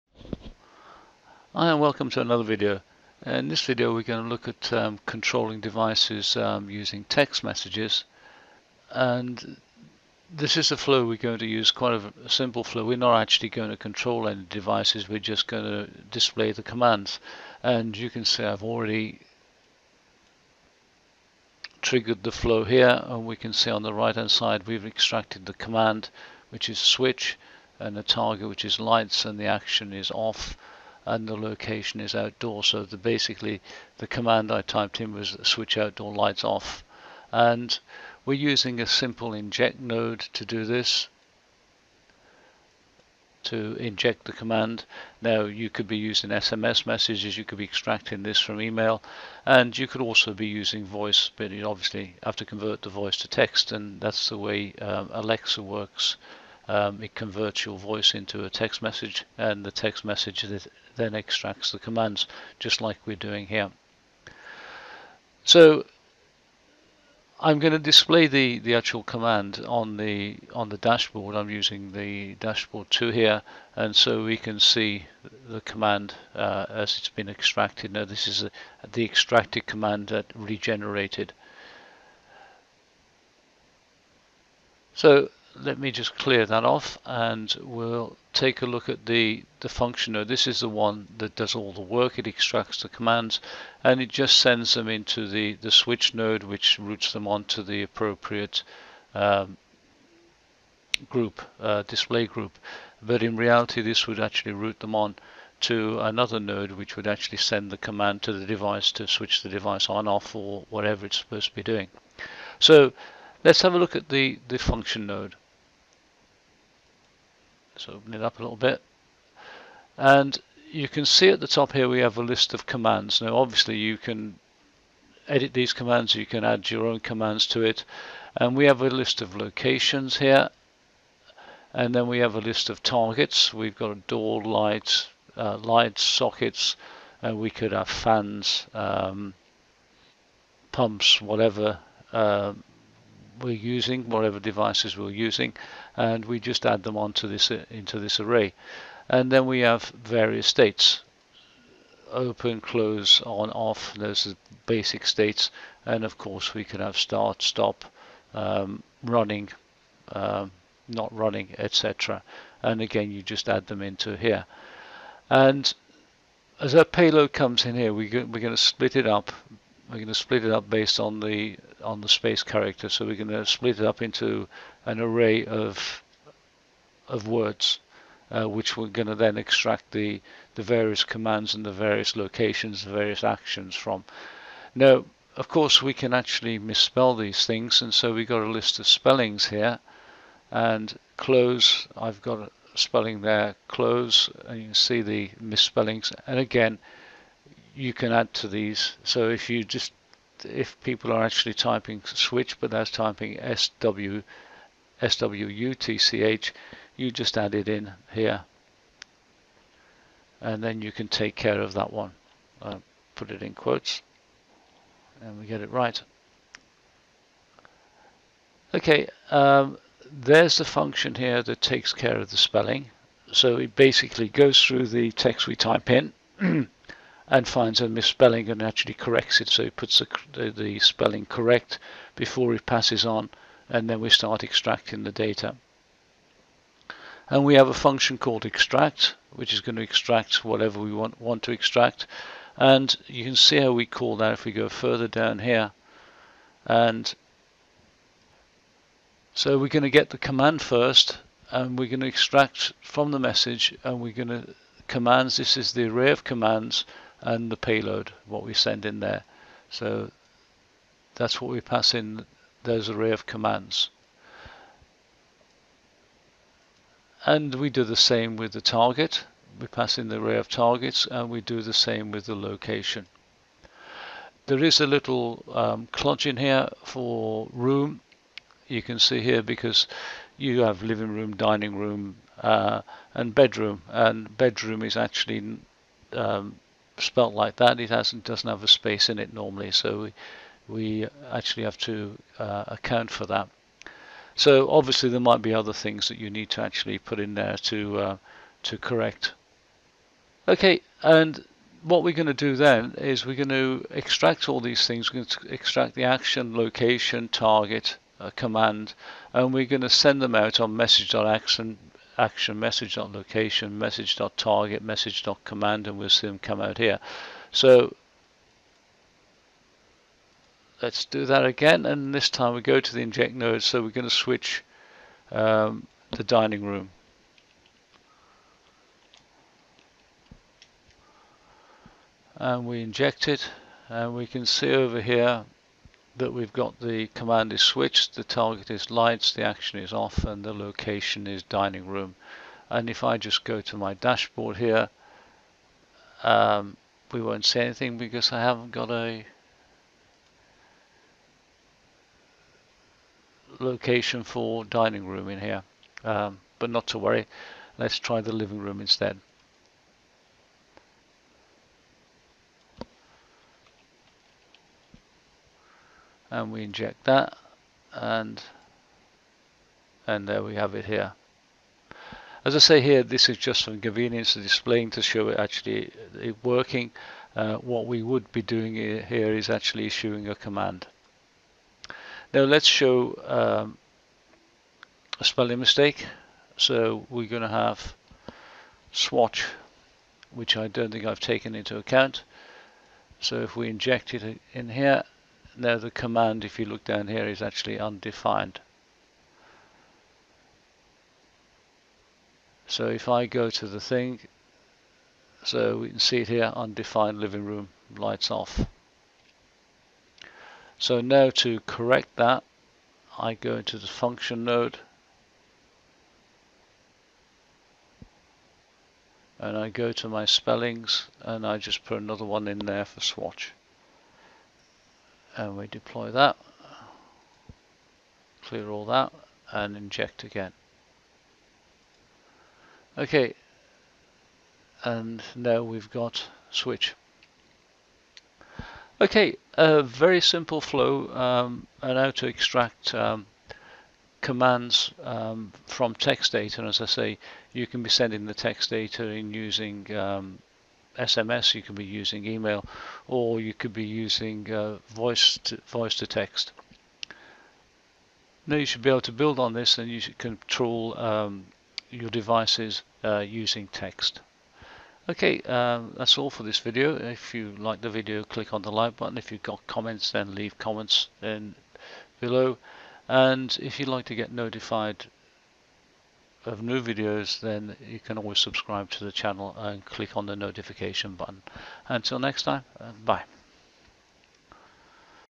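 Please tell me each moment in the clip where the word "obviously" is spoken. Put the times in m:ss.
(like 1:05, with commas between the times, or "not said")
0:51, 2:03, 4:54.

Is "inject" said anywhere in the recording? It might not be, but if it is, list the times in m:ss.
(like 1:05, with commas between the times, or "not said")
0:39, 0:43, 5:23, 5:32, 6:06, 6:33, 7:09.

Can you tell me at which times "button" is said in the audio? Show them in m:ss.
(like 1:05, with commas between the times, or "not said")
7:48, 8:01.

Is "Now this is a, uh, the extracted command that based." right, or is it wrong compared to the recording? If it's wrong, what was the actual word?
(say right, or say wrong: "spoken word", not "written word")
wrong: "regenerated", not "based".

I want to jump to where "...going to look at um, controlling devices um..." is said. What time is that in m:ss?
0:04.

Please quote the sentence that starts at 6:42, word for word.
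So if I go to the thing, so we can see it here, undefined living room, lights off.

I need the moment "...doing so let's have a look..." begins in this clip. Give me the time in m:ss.
1:51.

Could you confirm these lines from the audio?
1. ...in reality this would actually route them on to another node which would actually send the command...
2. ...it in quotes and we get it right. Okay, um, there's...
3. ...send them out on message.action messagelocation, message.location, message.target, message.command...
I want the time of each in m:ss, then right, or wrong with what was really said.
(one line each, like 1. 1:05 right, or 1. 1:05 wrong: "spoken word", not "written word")
1. 1:43 right
2. 3:33 right
3. 5:09 wrong: "action", not "messagelocation".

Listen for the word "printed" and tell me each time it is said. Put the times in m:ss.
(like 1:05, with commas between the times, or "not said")
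not said.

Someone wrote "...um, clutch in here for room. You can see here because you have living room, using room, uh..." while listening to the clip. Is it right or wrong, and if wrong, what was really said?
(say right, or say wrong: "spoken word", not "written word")
wrong: "dining", not "using".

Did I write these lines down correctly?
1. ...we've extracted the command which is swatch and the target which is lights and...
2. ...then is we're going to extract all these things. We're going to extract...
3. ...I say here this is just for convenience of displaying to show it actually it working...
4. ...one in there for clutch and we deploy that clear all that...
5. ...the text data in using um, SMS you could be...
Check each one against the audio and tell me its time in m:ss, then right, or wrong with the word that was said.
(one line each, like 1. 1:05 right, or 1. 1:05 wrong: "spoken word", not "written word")
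1. 0:24 wrong: "switch", not "swatch"
2. 5:02 right
3. 6:12 right
4. 7:02 wrong: "swatch", not "clutch"
5. 7:28 right.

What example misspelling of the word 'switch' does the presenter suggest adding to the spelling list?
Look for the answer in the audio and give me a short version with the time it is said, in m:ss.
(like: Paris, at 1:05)
SWUTCH, at 3:25.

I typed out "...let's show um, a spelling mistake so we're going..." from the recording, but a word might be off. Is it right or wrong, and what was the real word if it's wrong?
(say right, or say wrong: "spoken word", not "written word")
right.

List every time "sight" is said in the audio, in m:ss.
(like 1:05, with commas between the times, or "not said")
not said.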